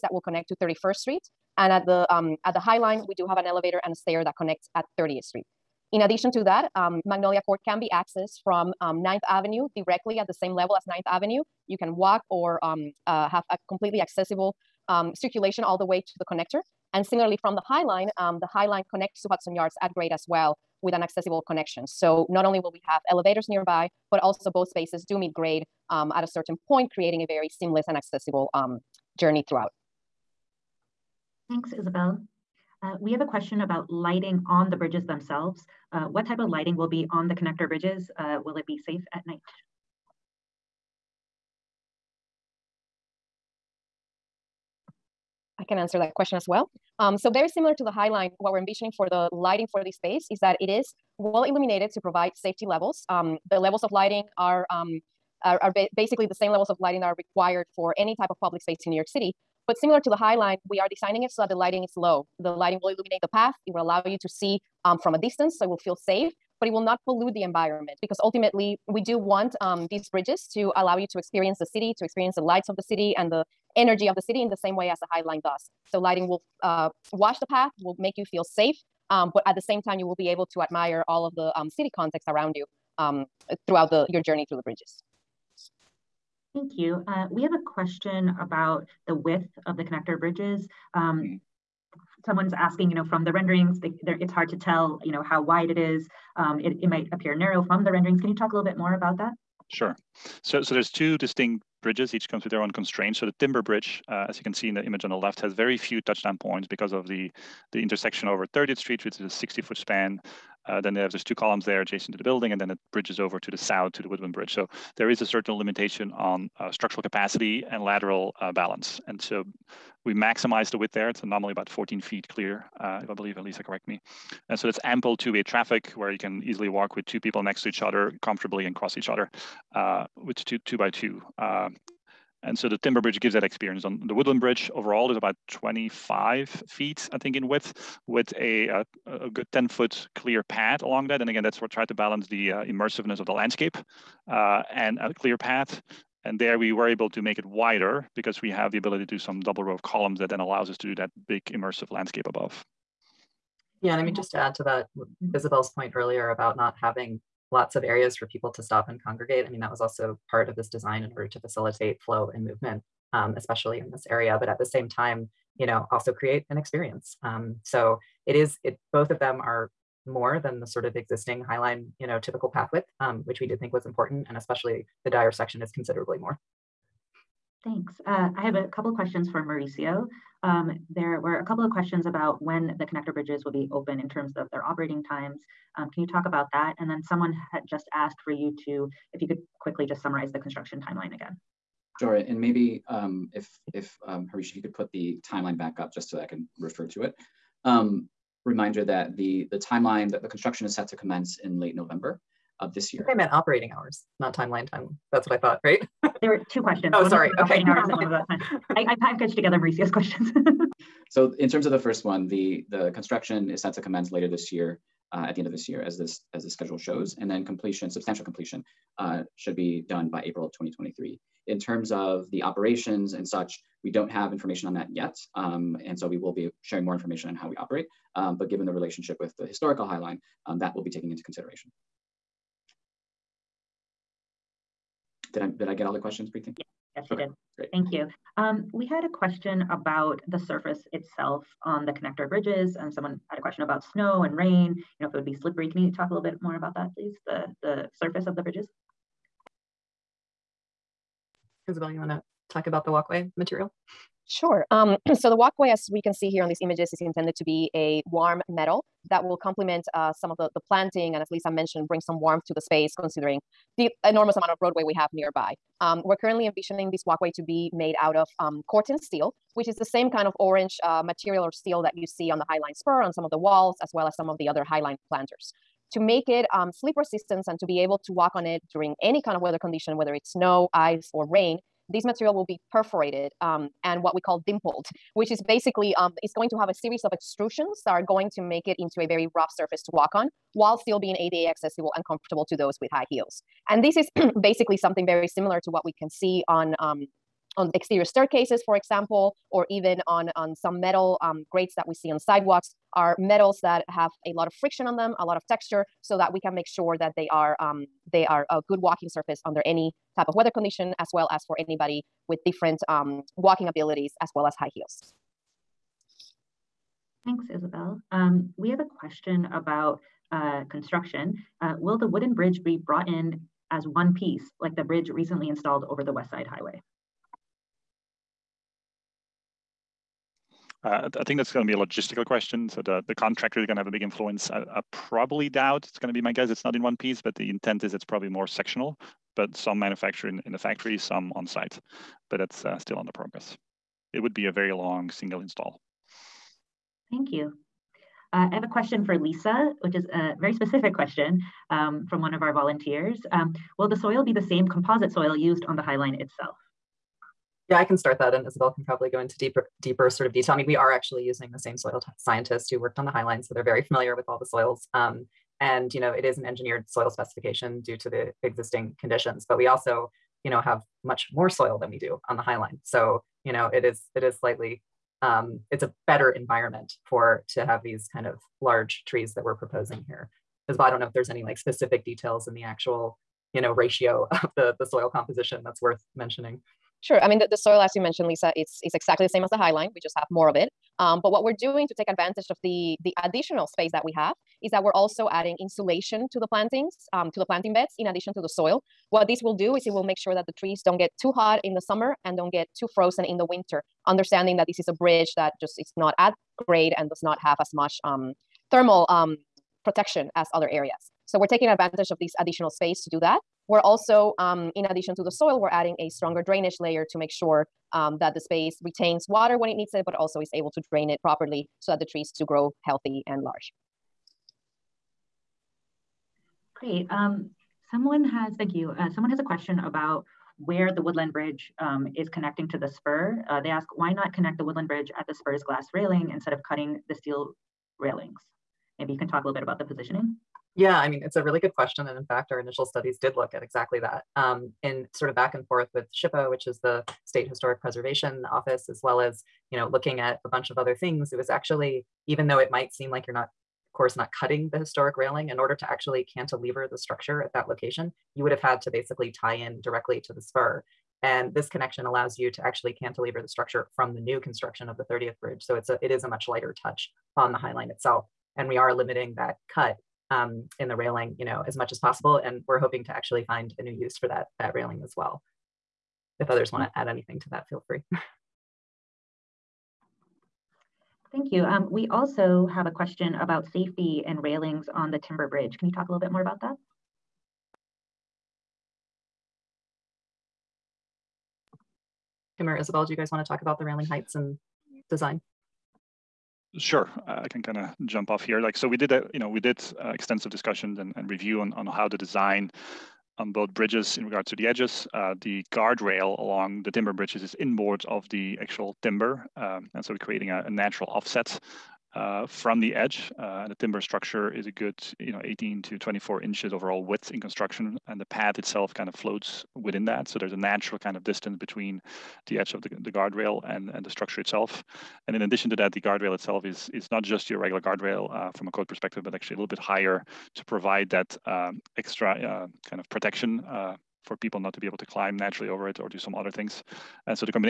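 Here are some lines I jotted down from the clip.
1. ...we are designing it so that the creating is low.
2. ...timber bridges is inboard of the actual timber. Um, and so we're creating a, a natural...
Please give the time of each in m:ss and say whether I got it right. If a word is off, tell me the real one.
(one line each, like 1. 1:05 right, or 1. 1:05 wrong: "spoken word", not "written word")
1. 1:00 wrong: "lighting", not "creating"
2. 8:26 right.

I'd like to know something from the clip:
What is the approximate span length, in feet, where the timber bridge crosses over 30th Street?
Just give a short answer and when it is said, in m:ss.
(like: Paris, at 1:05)
60 feet, at 1:49.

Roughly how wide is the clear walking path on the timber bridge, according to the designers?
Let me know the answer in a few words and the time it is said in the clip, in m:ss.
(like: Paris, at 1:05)
14 feet, at 2:01.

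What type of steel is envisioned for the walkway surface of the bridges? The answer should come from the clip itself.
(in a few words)
Corten steel.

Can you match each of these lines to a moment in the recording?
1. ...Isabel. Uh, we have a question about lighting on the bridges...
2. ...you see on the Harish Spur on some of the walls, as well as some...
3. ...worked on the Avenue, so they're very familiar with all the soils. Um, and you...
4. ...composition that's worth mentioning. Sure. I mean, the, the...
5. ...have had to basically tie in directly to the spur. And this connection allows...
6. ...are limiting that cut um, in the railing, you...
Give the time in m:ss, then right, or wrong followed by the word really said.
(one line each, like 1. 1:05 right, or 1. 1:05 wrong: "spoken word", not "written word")
1. 0:31 right
2. 4:31 wrong: "Highline", not "Harish"
3. 6:02 wrong: "Highline", not "Avenue"
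4. 6:25 right
5. 7:38 right
6. 7:48 right.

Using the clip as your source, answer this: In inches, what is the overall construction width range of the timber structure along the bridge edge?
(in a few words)
18 to 24 inches.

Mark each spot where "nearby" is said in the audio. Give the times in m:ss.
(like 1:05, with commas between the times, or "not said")
0:23, 4:25.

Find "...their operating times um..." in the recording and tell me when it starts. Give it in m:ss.
3:04.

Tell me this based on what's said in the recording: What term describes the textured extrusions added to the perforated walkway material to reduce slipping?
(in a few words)
Dimpled.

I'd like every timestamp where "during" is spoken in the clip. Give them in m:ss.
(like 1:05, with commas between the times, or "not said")
4:38.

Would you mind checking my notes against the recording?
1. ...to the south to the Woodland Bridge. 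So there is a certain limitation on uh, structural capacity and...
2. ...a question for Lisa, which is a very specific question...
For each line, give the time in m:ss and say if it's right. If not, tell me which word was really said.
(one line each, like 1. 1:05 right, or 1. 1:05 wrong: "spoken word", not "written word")
1. 1:53 right
2. 5:48 right.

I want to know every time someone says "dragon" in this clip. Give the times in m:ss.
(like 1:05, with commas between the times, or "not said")
not said.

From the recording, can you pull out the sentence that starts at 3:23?
I, I meant operating hours, not timeline.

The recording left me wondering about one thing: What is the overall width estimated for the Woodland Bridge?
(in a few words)
25 feet.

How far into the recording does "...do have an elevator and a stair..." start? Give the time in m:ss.
0:03.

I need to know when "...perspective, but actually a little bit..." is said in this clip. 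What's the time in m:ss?
8:48.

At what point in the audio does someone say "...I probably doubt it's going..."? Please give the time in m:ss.
5:34.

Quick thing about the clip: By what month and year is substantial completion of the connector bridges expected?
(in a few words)
April 2023.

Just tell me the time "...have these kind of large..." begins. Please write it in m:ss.
6:17.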